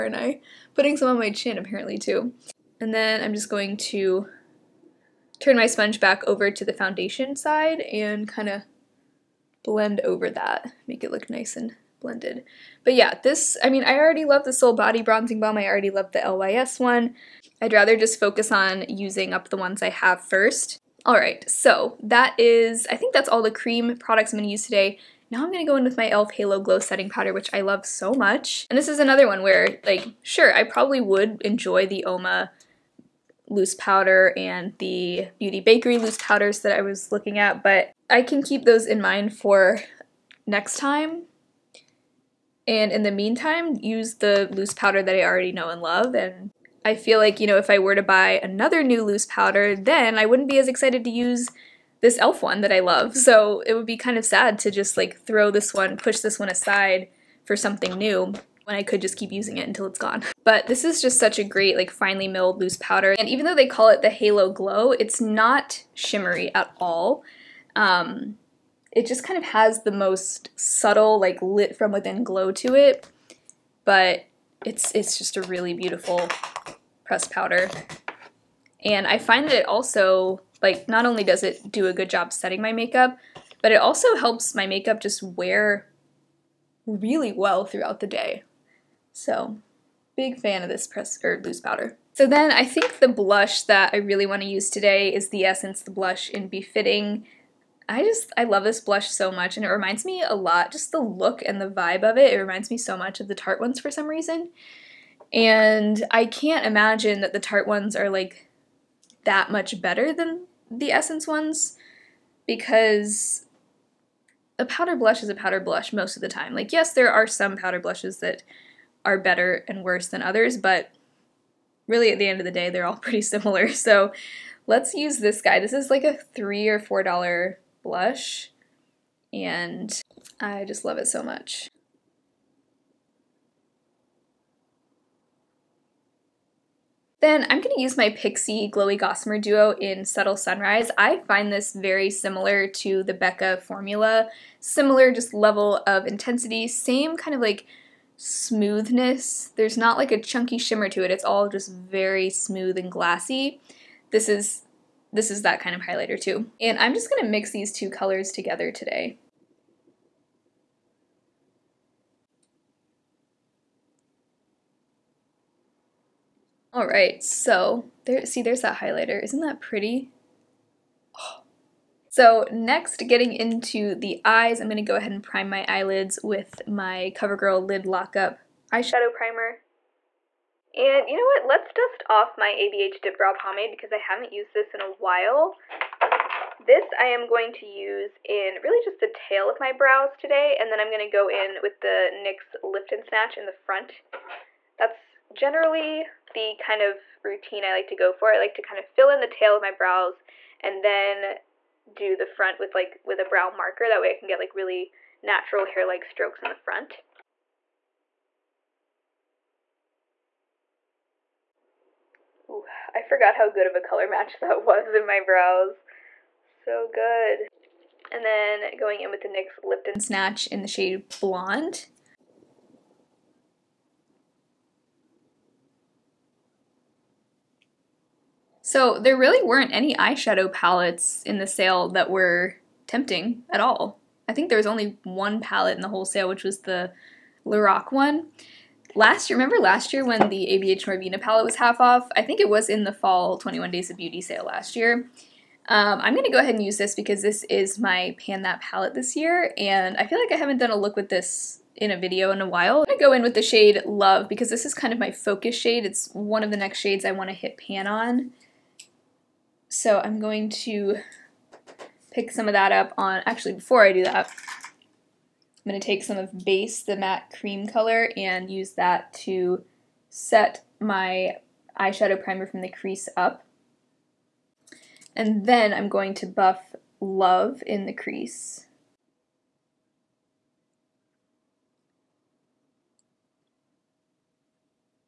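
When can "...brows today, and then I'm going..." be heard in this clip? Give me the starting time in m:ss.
3:09.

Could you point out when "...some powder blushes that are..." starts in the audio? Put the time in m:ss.
1:57.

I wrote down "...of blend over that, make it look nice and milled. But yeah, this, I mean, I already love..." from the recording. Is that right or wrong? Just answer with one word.
wrong.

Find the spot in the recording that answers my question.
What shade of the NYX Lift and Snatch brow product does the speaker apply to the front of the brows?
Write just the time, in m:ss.
3:41.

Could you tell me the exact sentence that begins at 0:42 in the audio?
And in the meantime, use the loose powder that I already know and love.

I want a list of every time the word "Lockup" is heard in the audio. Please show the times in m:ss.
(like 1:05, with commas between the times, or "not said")
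2:57.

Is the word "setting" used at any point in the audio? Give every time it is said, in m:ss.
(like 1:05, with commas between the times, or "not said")
0:26, 1:22.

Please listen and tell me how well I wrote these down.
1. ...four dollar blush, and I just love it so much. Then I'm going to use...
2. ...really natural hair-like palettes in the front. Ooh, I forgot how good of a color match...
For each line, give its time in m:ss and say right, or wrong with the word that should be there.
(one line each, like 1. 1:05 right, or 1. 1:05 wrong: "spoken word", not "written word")
1. 2:06 right
2. 3:24 wrong: "strokes", not "palettes".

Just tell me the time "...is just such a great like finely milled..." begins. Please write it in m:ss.
1:00.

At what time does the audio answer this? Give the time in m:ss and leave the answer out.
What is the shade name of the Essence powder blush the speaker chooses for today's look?
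1:36.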